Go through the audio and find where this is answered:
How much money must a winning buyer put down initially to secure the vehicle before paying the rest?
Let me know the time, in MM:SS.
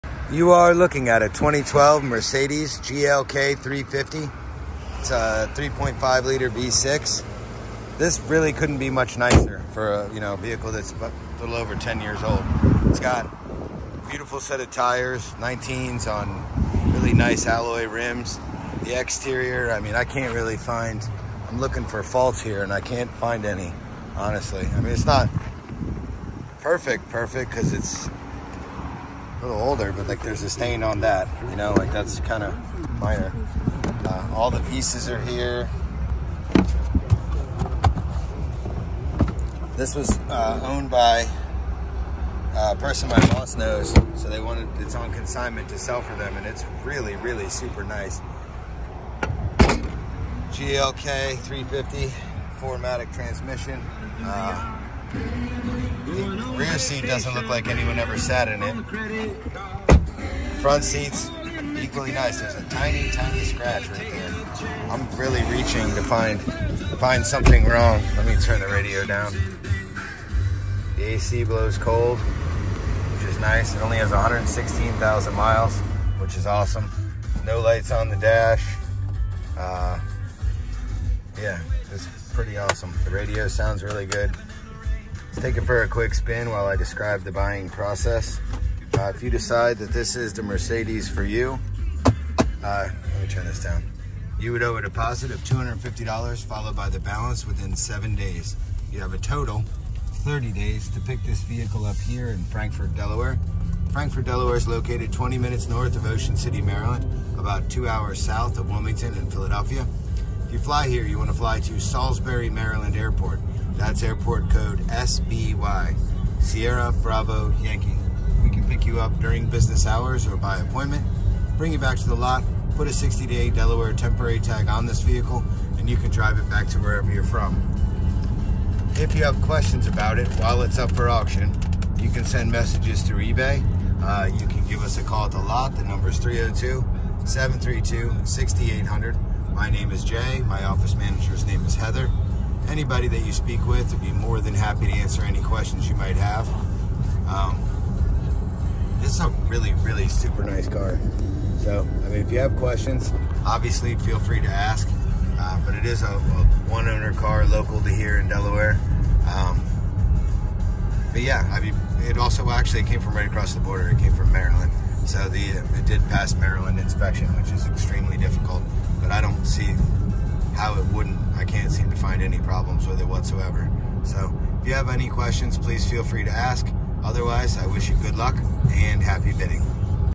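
01:35.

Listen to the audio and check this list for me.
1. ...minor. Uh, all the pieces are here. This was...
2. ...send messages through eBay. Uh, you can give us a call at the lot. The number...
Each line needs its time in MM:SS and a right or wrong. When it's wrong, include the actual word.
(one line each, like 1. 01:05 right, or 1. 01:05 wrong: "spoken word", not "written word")
1. 00:32 right
2. 02:12 right.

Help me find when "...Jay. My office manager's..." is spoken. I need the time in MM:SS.
02:20.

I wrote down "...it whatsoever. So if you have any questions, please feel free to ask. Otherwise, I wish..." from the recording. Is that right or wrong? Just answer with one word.
right.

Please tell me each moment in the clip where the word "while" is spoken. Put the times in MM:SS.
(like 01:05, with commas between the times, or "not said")
01:26, 02:10.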